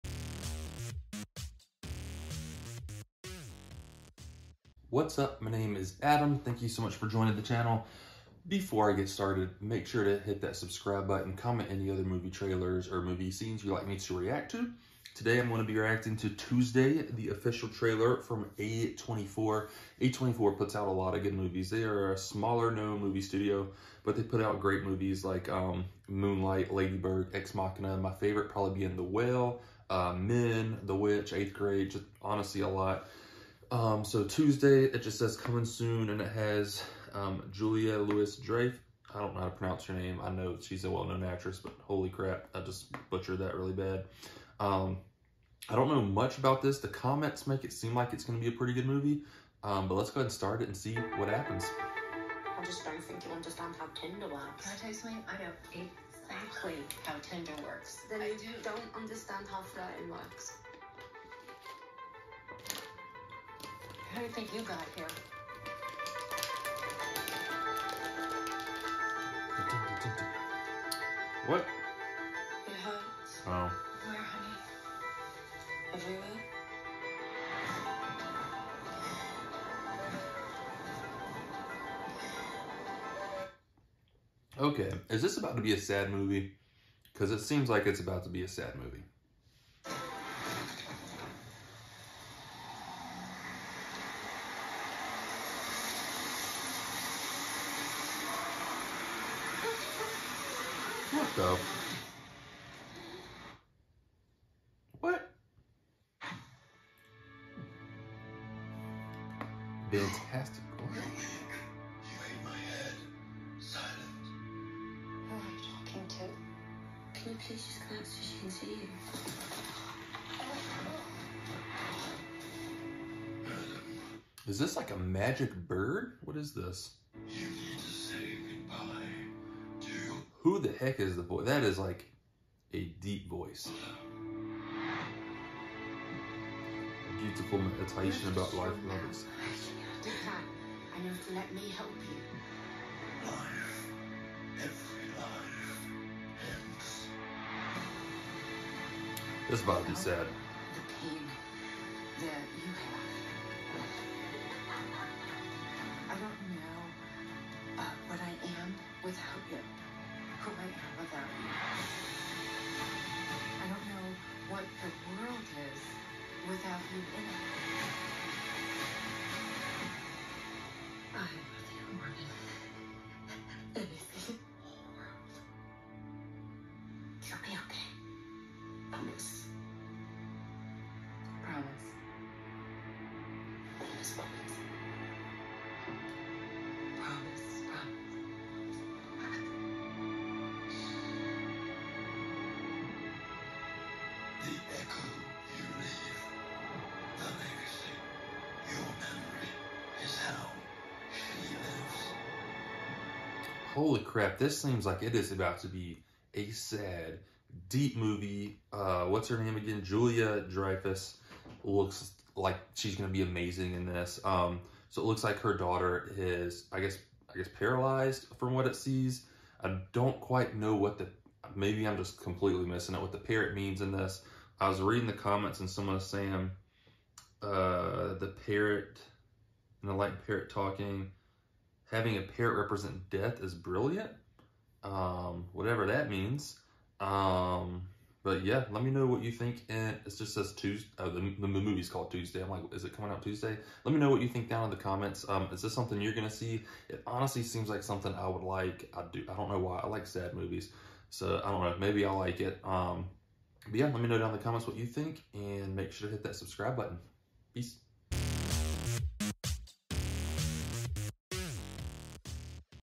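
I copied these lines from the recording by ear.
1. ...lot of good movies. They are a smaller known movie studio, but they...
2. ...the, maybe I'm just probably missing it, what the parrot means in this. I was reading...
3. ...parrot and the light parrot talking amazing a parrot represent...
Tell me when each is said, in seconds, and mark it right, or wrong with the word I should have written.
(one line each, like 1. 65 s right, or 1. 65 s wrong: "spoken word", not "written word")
1. 20 s right
2. 220 s wrong: "completely", not "probably"
3. 228 s wrong: "having", not "amazing".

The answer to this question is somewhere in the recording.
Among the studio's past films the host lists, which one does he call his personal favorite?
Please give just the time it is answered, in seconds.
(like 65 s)
28 s.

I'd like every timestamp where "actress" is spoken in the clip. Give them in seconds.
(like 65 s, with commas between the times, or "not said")
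41 s.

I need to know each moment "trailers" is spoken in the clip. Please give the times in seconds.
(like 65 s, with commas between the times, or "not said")
12 s, 17 s.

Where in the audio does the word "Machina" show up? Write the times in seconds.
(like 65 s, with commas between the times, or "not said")
27 s.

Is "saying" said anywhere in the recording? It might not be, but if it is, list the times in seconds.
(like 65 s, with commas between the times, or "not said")
226 s.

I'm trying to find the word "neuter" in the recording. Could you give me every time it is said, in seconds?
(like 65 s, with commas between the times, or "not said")
not said.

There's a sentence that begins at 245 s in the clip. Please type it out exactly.
Um, is this something you're gonna see?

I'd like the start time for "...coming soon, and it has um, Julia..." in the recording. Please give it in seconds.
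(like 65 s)
35 s.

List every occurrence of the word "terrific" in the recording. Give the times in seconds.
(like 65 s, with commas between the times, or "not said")
not said.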